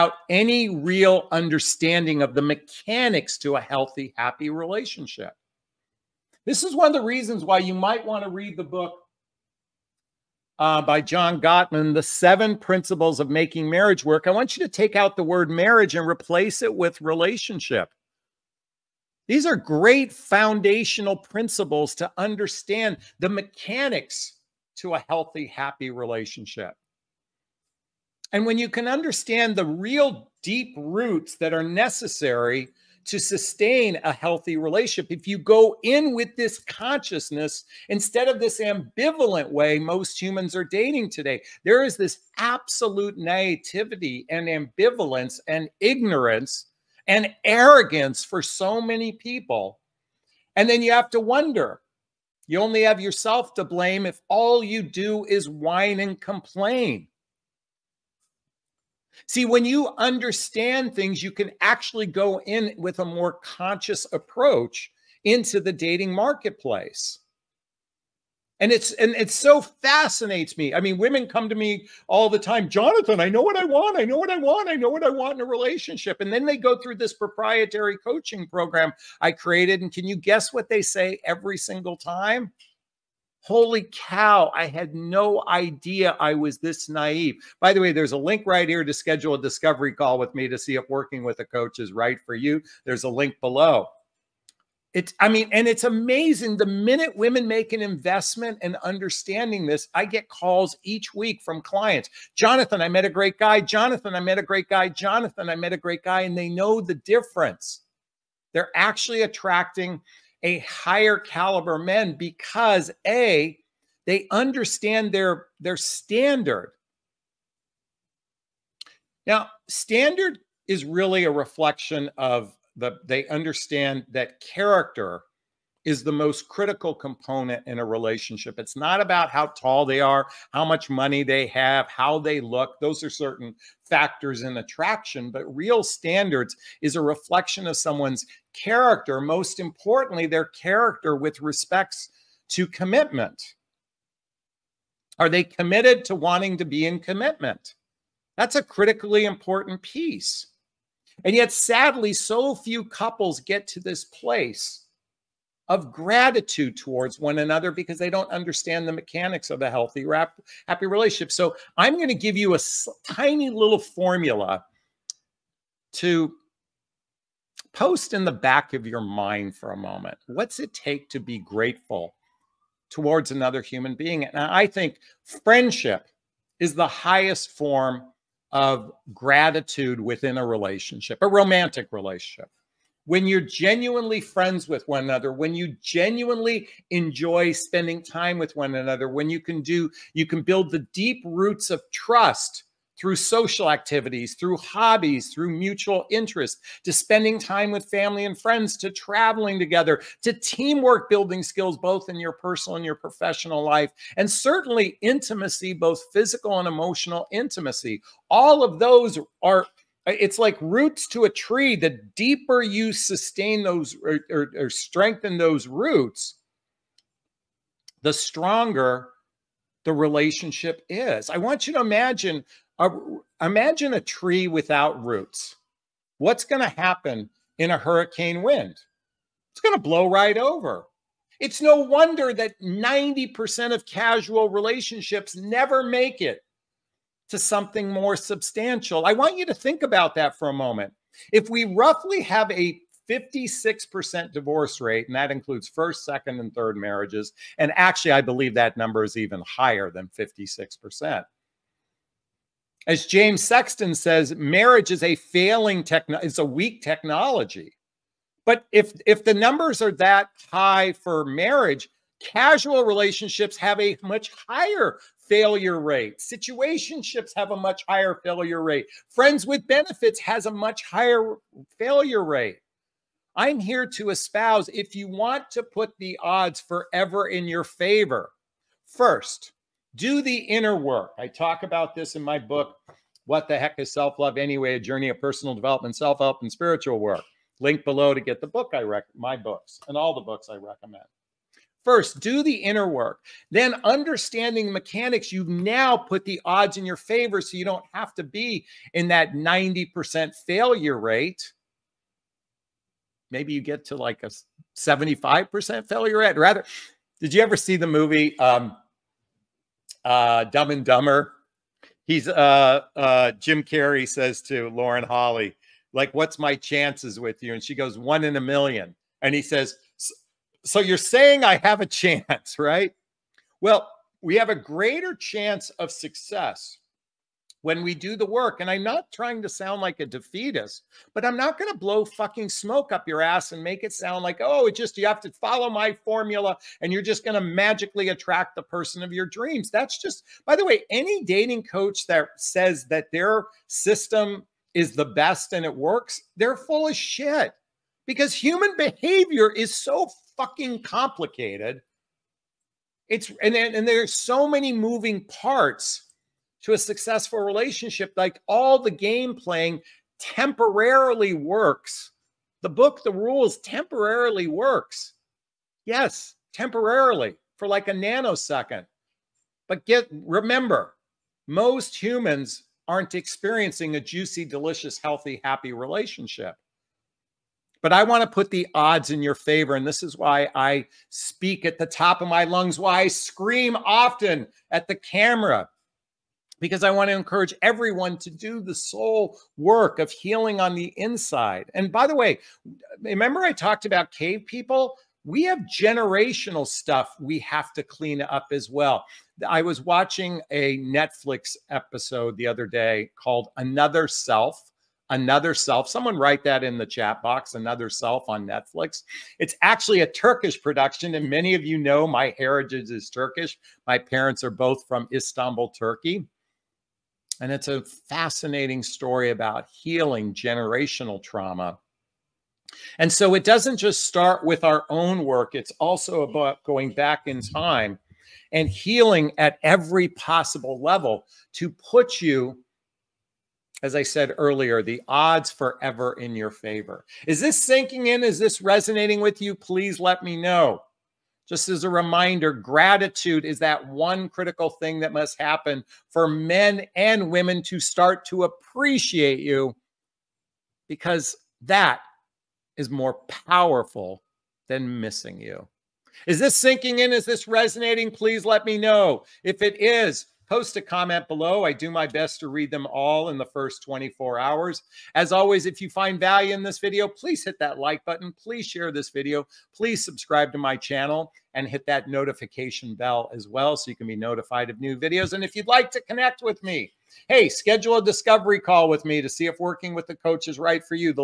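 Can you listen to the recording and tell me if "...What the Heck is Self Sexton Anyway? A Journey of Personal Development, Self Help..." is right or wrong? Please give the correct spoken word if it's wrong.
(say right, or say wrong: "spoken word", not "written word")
wrong: "Love", not "Sexton".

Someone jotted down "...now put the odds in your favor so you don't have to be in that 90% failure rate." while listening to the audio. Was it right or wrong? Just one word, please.
right.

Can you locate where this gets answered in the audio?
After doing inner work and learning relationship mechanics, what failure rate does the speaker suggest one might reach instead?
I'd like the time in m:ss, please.
5:04.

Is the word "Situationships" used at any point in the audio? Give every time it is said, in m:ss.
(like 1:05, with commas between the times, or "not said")
4:26.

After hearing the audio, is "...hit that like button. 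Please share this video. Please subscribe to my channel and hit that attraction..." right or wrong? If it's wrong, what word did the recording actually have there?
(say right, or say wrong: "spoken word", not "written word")
wrong: "notification", not "attraction".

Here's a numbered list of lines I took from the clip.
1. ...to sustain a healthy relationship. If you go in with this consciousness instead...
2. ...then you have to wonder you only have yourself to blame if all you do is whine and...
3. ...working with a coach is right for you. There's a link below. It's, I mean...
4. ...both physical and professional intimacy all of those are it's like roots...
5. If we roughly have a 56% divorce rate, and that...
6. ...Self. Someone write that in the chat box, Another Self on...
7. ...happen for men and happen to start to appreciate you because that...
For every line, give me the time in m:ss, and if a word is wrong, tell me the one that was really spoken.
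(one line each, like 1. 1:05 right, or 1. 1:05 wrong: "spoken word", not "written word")
1. 0:33 right
2. 0:50 right
3. 1:30 right
4. 3:25 wrong: "emotional", not "professional"
5. 4:01 right
6. 6:45 right
7. 7:25 wrong: "women", not "happen".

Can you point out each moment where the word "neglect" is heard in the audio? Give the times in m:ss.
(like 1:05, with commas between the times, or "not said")
not said.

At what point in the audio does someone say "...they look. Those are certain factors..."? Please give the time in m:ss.
2:12.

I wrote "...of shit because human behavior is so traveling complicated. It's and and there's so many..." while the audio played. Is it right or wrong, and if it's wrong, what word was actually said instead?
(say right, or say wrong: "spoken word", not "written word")
wrong: "fucking", not "traveling".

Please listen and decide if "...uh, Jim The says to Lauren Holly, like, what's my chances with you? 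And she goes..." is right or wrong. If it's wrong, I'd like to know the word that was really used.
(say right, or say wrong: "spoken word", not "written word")
wrong: "Carrey", not "The".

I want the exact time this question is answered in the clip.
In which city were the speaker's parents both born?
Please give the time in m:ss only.
6:55.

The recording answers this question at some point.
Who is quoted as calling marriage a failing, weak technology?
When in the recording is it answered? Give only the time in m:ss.
4:13.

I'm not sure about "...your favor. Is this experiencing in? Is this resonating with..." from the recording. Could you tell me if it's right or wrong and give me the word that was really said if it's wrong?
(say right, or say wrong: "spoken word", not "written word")
wrong: "sinking", not "experiencing".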